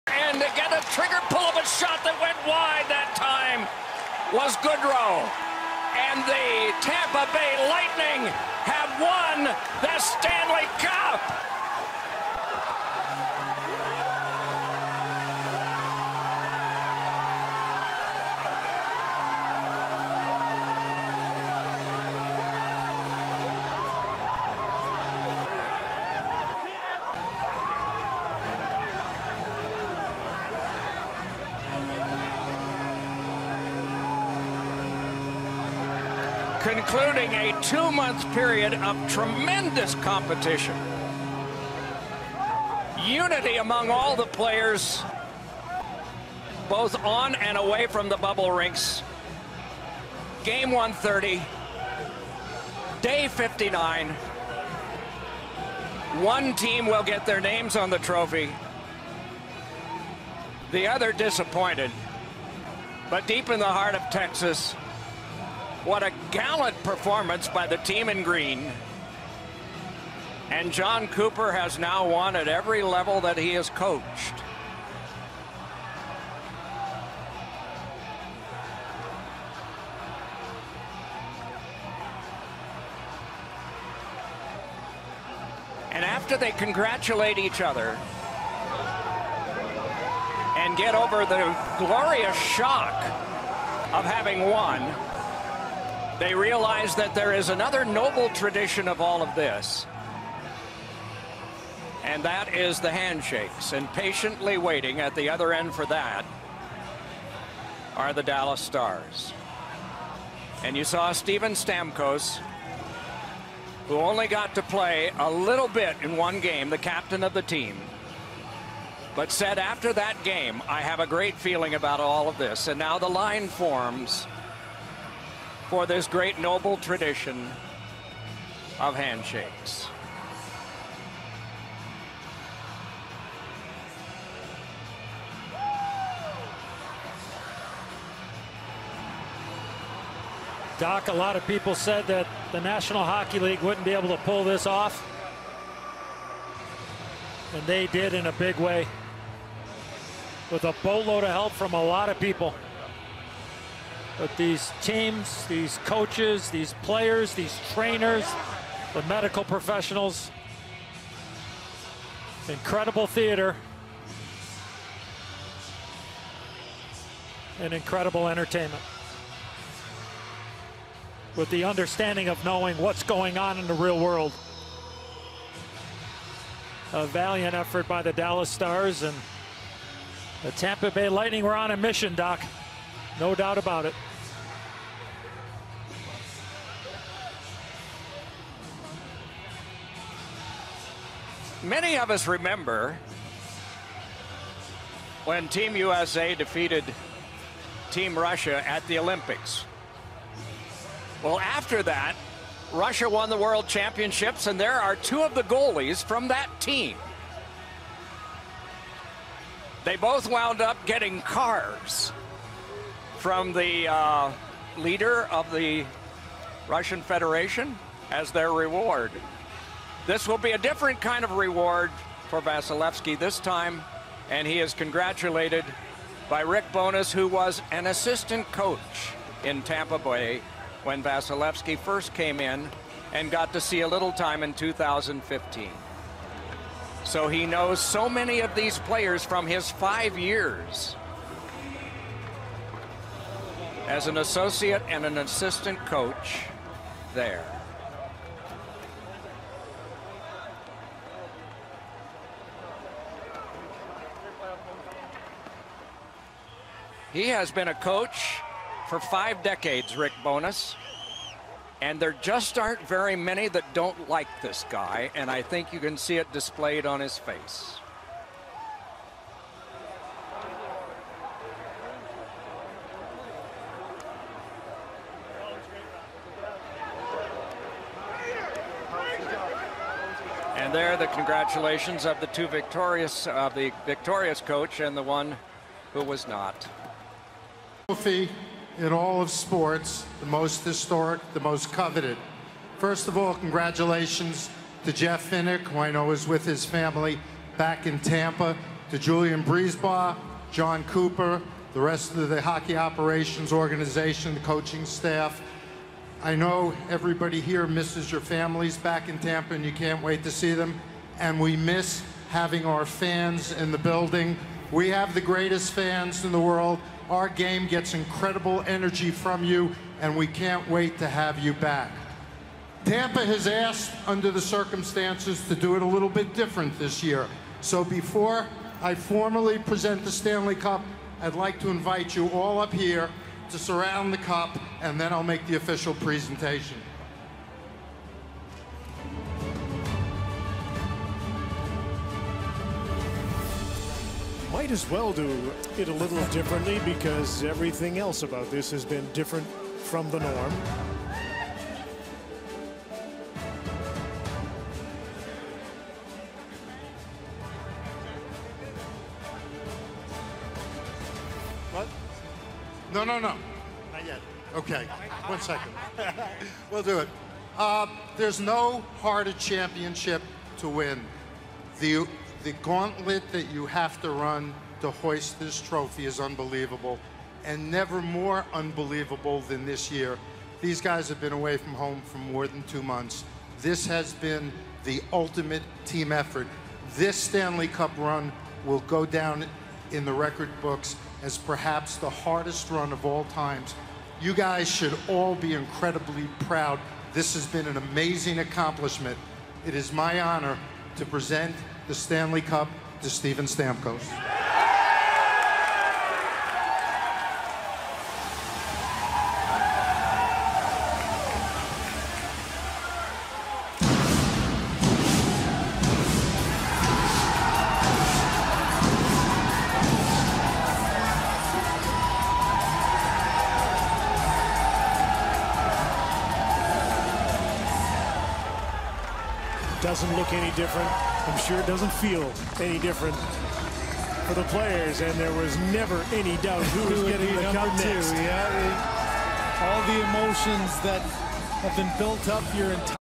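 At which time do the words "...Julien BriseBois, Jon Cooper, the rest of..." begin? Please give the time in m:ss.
4:58.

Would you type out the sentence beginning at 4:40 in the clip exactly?
And there, the congratulations of the two victorious, of uh, the victorious coach and the one who was not.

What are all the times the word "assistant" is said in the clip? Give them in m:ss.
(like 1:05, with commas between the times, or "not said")
3:47, 4:05.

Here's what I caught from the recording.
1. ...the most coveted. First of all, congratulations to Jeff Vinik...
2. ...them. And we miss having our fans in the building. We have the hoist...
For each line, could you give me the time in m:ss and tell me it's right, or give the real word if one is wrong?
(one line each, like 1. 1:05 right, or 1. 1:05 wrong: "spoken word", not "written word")
1. 4:51 right
2. 5:10 wrong: "greatest", not "hoist".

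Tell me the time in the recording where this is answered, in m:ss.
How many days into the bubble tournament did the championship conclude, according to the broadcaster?
0:53.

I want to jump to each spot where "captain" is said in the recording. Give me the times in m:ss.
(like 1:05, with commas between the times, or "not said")
1:56.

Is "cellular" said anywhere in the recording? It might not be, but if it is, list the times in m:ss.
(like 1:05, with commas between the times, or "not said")
not said.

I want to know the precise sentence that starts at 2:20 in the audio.
Doc, a lot of people said that the National Hockey League wouldn't be able to pull this off.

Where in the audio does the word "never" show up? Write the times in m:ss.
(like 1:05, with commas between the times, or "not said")
6:17, 7:15.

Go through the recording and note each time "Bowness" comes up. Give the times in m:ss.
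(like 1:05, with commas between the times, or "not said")
3:46, 4:20.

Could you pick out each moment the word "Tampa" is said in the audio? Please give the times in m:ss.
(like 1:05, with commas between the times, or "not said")
0:06, 3:00, 3:49, 4:57, 5:09, 5:22.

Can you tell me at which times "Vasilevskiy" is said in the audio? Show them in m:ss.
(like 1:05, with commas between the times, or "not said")
3:42, 3:51.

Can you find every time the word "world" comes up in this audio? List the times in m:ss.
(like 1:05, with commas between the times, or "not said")
2:53, 3:23, 5:16.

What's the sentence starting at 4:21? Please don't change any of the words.
And there just aren't very many that don't like this guy, and I think you can see it displayed on his face.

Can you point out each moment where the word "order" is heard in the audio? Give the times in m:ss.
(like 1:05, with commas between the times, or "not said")
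not said.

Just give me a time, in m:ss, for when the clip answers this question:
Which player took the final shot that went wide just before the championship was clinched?
0:04.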